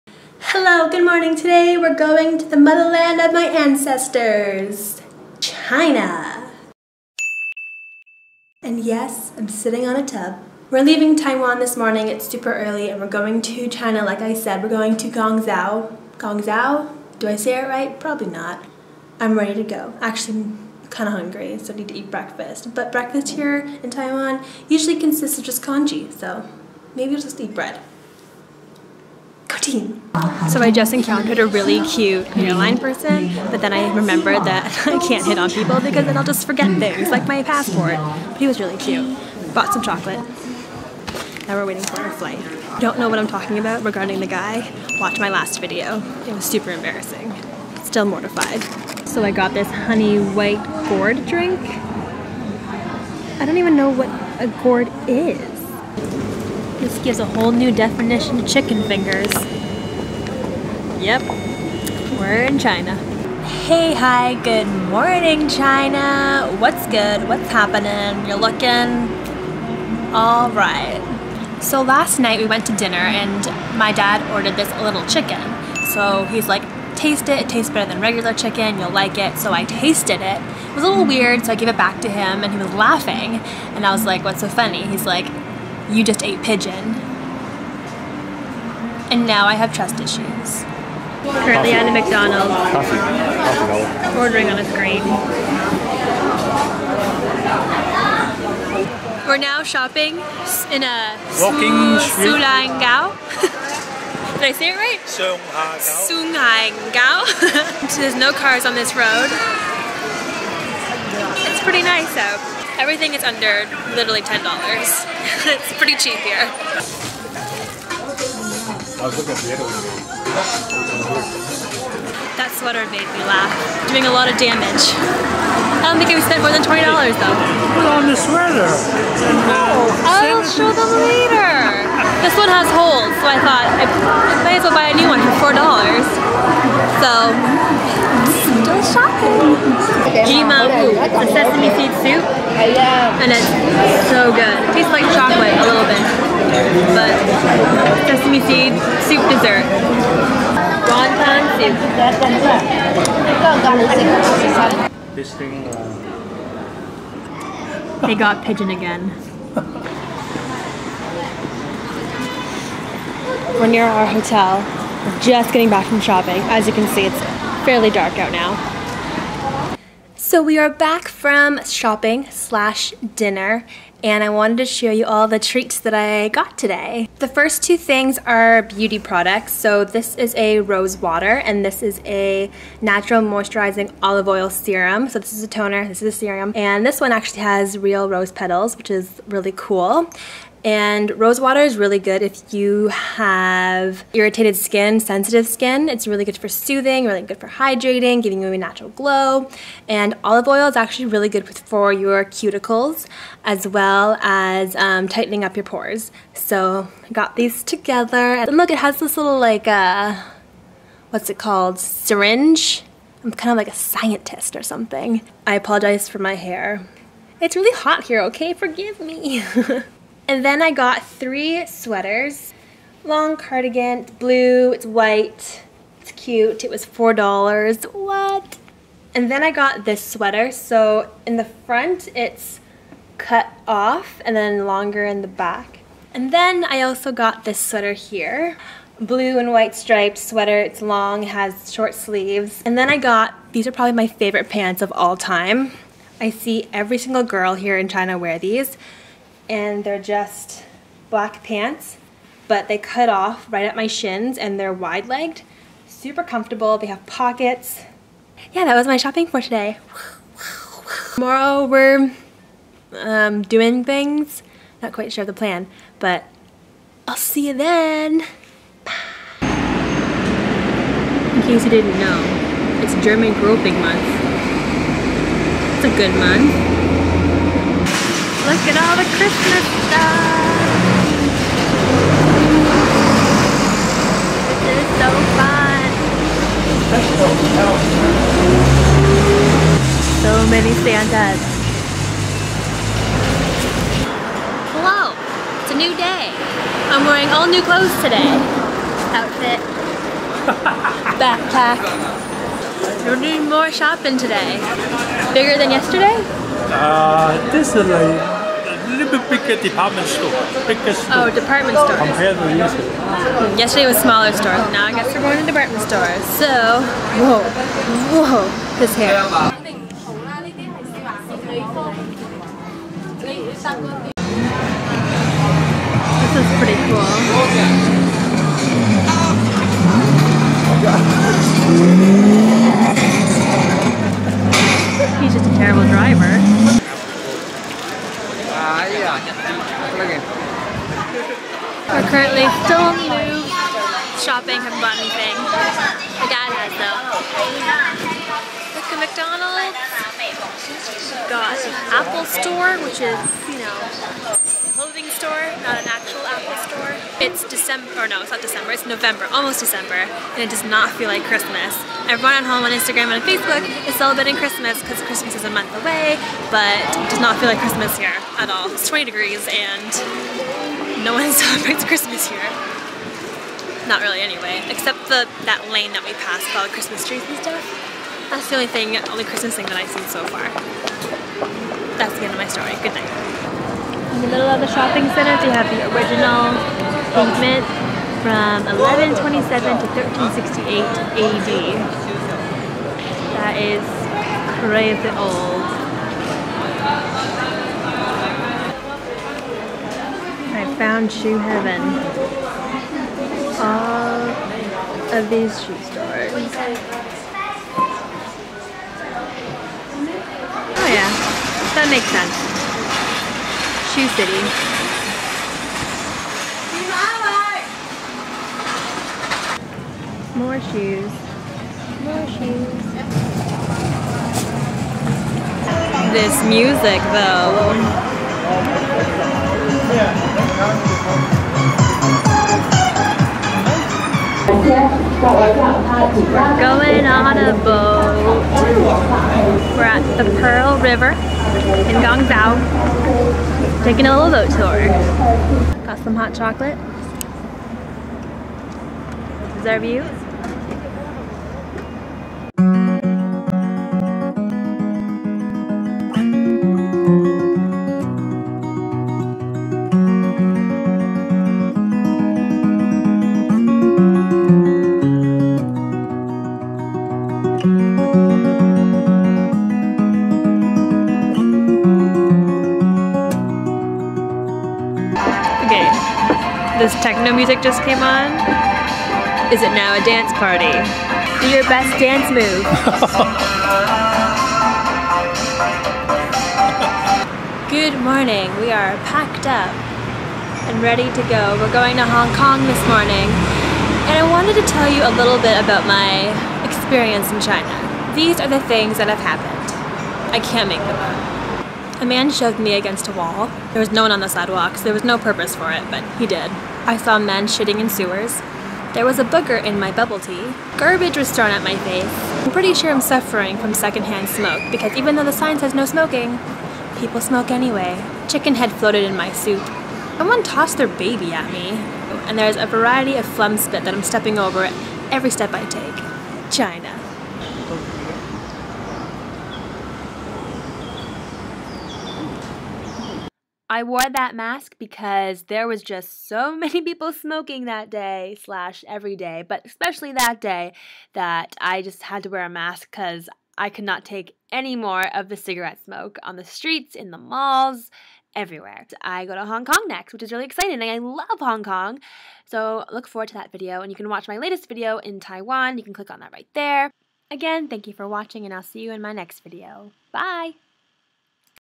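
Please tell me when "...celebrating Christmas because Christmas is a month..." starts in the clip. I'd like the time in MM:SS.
06:03.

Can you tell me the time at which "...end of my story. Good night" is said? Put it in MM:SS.
06:22.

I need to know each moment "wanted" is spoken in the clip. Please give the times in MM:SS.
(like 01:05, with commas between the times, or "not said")
02:54, 08:14.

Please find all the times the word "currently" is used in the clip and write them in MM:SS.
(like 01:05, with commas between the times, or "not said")
01:31, 05:42.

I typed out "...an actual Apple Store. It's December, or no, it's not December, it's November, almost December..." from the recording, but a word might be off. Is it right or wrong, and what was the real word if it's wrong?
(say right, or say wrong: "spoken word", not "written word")
right.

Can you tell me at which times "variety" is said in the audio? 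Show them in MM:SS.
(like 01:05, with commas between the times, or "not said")
08:42.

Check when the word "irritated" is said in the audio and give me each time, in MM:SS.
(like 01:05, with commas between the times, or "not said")
03:14.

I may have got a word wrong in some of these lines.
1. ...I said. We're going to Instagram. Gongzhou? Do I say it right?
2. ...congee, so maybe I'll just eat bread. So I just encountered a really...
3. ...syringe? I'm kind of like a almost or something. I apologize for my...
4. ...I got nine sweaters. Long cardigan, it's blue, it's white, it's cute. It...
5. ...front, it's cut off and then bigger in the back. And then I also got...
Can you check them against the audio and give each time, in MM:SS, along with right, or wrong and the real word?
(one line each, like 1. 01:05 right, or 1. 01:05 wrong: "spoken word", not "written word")
1. 00:14 wrong: "Gongzhou", not "Instagram"
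2. 00:25 right
3. 03:31 wrong: "scientist", not "almost"
4. 03:40 wrong: "three", not "nine"
5. 03:51 wrong: "longer", not "bigger".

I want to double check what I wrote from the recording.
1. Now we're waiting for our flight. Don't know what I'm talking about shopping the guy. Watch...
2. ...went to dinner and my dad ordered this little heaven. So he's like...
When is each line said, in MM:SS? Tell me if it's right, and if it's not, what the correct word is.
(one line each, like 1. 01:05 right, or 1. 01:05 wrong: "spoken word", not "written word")
1. 00:41 wrong: "regarding", not "shopping"
2. 01:12 wrong: "chicken", not "heaven".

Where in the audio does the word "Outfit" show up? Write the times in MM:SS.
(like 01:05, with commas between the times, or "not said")
04:59.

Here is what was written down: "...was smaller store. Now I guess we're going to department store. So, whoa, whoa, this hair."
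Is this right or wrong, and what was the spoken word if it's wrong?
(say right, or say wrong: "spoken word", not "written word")
right.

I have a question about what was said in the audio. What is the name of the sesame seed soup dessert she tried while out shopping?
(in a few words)
Jima.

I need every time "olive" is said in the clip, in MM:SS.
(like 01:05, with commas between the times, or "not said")
03:04, 03:20.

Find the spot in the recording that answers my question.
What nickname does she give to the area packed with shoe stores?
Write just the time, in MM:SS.
06:53.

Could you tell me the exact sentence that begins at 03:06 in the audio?
And this one actually has real rose petals, which is really cool.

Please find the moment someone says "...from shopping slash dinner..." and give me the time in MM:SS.
02:51.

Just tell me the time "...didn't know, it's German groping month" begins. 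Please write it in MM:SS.
04:31.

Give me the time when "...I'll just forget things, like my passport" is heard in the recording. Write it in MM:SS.
00:36.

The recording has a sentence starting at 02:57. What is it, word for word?
The first two things are beauty products.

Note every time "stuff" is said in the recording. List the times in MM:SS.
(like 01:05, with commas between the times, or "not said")
04:39, 06:17.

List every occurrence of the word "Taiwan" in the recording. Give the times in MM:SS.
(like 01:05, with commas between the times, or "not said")
00:11, 00:23, 09:15.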